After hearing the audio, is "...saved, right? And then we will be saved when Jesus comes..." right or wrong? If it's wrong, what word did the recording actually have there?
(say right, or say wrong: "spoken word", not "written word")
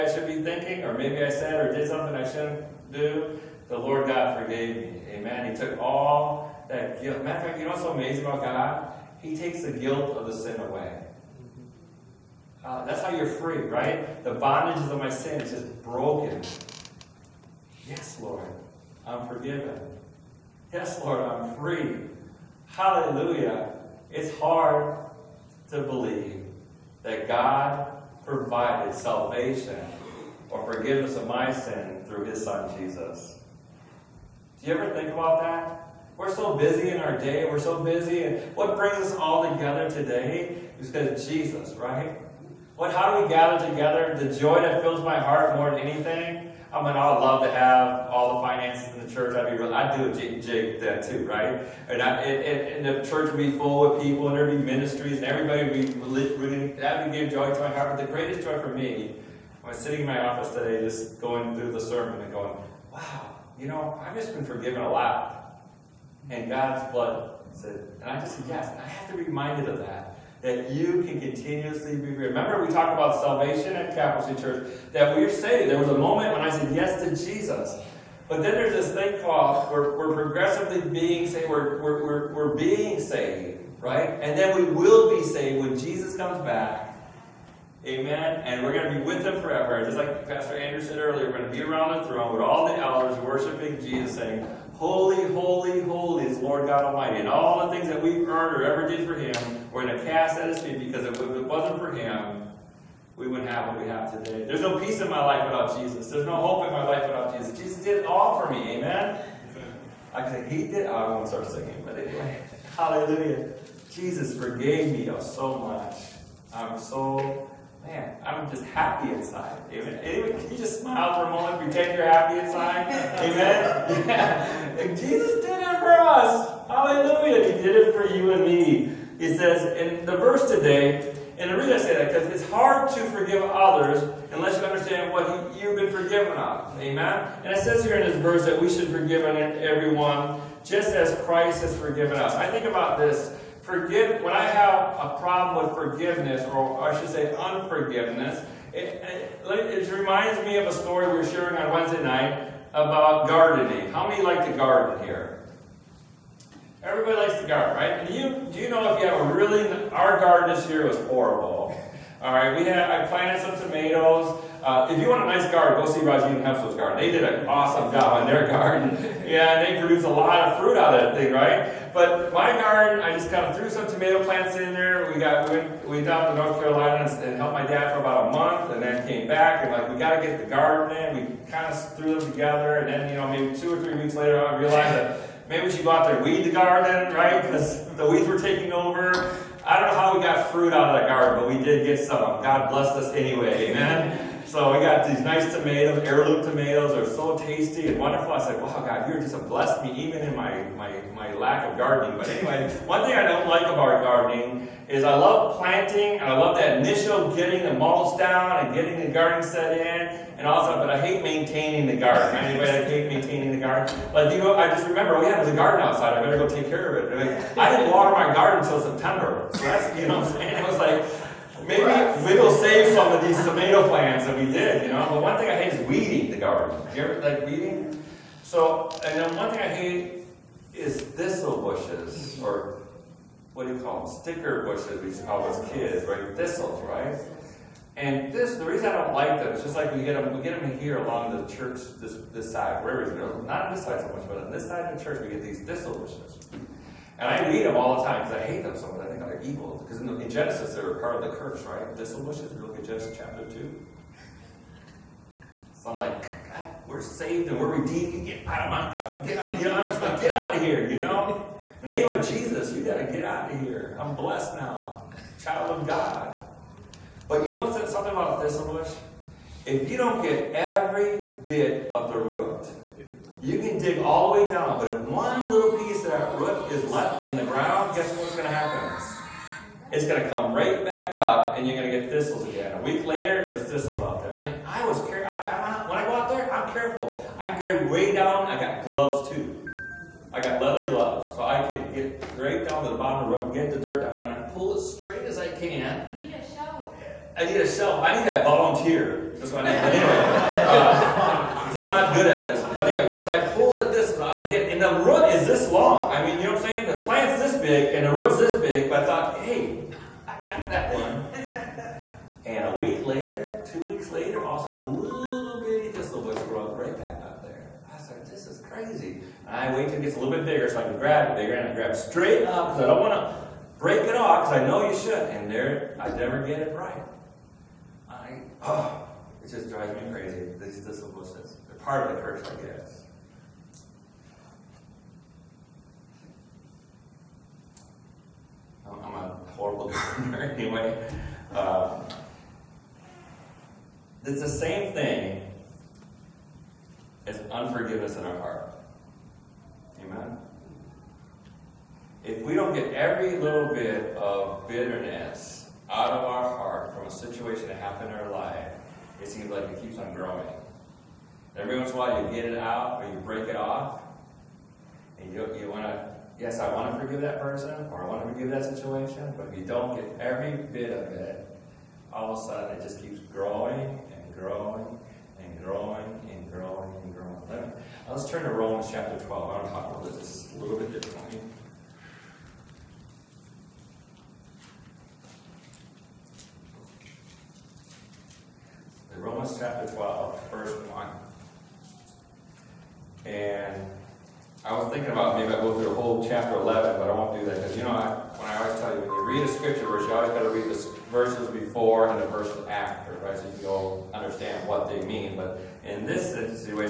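right.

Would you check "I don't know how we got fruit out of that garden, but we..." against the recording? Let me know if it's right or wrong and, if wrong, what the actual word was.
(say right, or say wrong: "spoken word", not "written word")
right.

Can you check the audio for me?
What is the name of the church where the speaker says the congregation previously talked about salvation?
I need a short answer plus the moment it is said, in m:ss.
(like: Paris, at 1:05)
Capital City Church, at 1:13.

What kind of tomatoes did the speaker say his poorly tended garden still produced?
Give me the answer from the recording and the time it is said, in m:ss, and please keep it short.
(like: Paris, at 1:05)
heirloom tomatoes, at 3:16.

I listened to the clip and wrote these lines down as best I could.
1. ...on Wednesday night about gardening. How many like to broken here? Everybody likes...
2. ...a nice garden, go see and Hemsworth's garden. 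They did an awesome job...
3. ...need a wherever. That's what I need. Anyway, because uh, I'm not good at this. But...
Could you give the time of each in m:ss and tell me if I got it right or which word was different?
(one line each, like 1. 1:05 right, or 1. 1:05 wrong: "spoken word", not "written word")
1. 2:31 wrong: "garden", not "broken"
2. 2:45 right
3. 4:58 wrong: "volunteer", not "wherever".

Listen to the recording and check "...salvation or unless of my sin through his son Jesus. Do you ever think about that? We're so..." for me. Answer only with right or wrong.
wrong.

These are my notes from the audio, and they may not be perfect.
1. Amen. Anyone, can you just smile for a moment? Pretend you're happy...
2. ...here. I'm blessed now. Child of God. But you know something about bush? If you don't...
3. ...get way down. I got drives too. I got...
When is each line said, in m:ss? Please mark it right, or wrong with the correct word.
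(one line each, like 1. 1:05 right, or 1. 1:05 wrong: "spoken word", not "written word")
1. 1:59 right
2. 4:23 right
3. 4:47 wrong: "gloves", not "drives".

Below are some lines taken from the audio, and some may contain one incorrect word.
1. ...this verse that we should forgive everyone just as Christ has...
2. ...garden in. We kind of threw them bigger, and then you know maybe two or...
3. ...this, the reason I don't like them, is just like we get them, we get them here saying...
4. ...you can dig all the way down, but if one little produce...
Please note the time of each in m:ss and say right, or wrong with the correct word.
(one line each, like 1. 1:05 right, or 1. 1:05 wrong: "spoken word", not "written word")
1. 2:18 right
2. 3:00 wrong: "together", not "bigger"
3. 3:58 wrong: "along", not "saying"
4. 4:33 wrong: "piece", not "produce".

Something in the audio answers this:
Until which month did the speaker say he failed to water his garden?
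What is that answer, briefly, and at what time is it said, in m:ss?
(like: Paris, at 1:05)
September, at 3:38.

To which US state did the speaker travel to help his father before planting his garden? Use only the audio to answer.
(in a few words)
North Carolina.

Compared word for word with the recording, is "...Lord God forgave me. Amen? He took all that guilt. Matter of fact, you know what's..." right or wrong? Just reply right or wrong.
right.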